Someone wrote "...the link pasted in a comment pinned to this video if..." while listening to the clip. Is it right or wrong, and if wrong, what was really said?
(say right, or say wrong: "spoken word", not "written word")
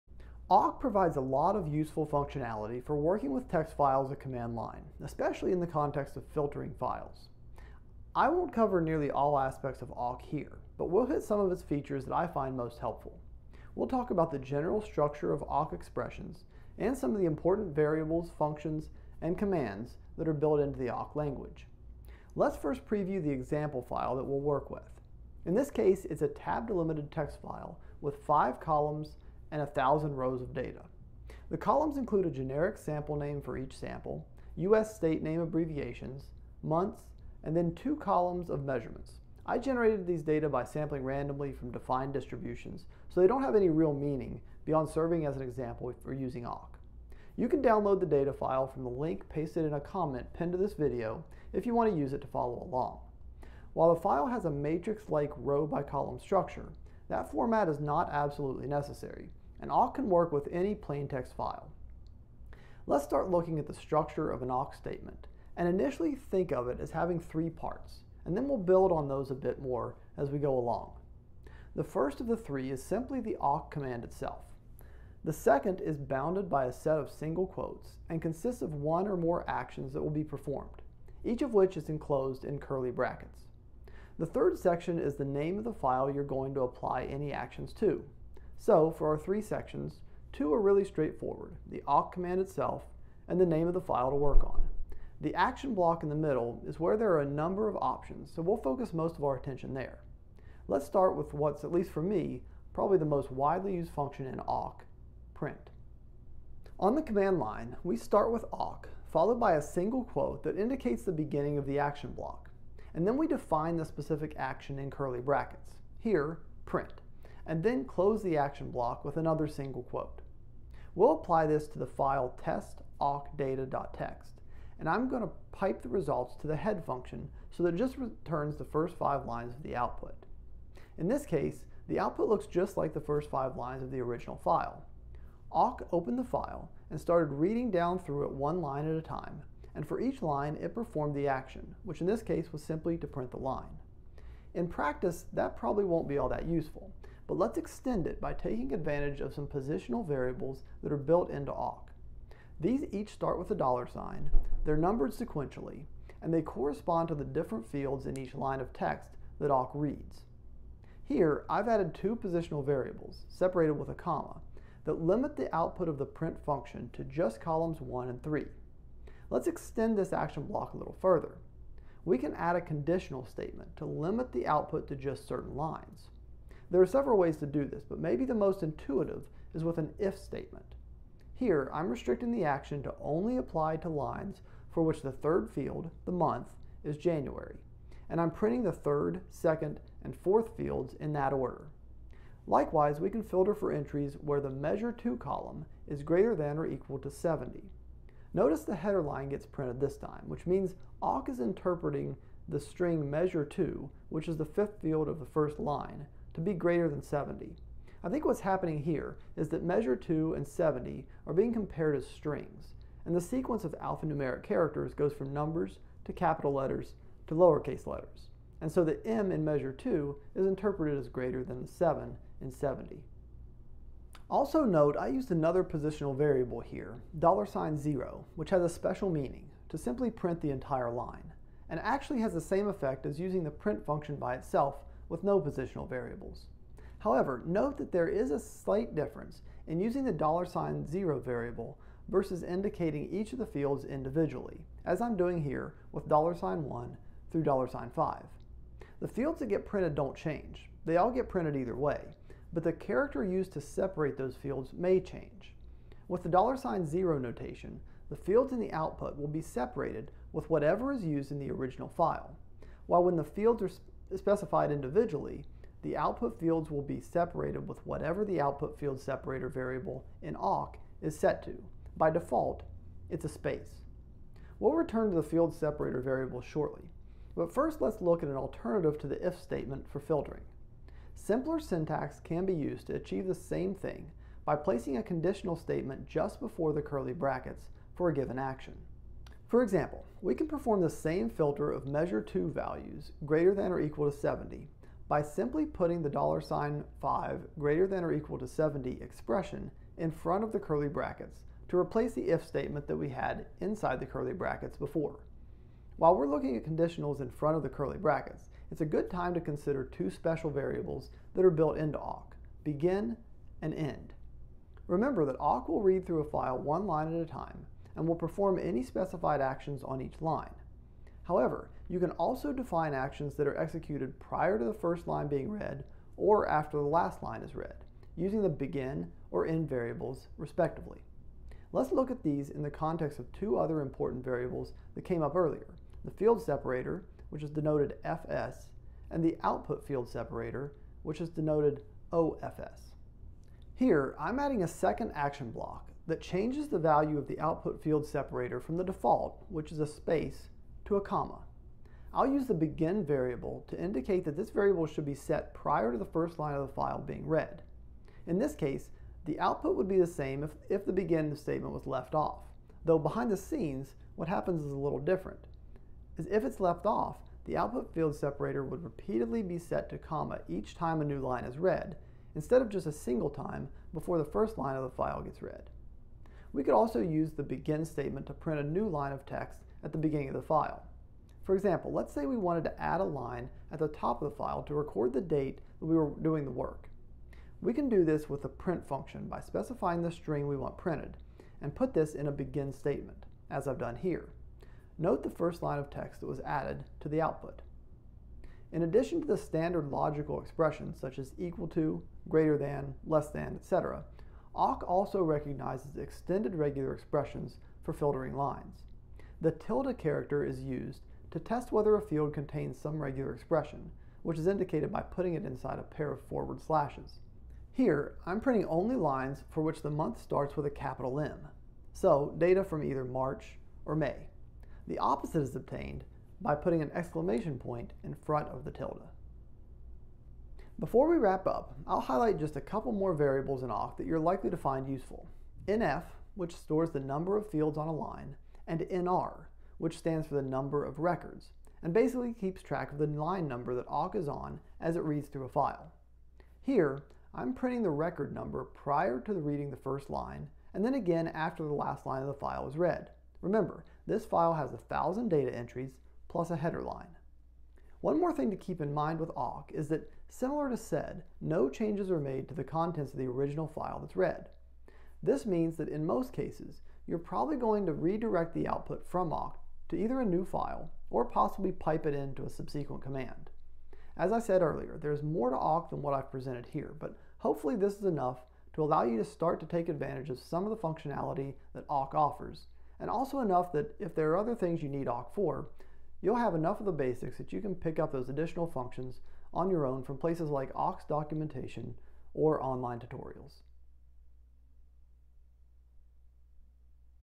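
right.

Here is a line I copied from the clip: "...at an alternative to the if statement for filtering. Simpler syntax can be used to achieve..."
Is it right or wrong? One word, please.
right.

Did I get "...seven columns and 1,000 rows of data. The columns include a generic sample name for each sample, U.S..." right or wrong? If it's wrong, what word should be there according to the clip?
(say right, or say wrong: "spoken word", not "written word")
wrong: "five", not "seven".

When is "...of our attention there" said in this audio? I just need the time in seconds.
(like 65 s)
99 s.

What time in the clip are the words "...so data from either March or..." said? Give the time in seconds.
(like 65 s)
421 s.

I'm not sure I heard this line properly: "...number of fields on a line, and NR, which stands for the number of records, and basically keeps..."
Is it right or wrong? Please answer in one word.
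right.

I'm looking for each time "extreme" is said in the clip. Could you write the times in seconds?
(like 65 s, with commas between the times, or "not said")
not said.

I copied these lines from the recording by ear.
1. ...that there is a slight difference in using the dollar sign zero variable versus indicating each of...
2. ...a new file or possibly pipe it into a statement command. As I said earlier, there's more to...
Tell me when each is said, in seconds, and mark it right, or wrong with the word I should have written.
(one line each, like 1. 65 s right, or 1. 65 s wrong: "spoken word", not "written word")
1. 237 s right
2. 470 s wrong: "subsequent", not "statement".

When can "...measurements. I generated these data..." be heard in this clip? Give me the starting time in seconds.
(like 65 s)
38 s.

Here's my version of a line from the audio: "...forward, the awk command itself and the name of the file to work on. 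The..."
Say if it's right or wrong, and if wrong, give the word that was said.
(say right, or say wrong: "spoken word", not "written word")
wrong: "straightforward", not "forward".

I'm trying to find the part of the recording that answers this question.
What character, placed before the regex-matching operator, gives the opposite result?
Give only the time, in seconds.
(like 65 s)
426 s.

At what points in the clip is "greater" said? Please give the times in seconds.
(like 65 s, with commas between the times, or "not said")
196 s, 206 s, 221 s, 293 s, 297 s, 402 s.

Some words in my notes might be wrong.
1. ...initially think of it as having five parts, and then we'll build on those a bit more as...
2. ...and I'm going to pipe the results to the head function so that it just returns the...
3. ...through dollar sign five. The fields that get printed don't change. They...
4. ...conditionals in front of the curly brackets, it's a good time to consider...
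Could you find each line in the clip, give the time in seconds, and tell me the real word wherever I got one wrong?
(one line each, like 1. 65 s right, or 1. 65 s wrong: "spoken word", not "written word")
1. 65 s wrong: "three", not "five"
2. 124 s right
3. 247 s right
4. 306 s right.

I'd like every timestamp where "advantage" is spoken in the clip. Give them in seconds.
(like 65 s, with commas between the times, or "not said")
148 s, 479 s.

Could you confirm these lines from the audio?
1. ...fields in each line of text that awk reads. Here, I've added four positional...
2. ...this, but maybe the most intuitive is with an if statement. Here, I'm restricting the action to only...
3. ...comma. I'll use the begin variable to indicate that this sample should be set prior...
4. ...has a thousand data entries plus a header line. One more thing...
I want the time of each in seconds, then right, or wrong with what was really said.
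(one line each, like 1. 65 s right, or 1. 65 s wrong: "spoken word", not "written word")
1. 157 s wrong: "two", not "four"
2. 177 s right
3. 351 s wrong: "variable", not "sample"
4. 454 s right.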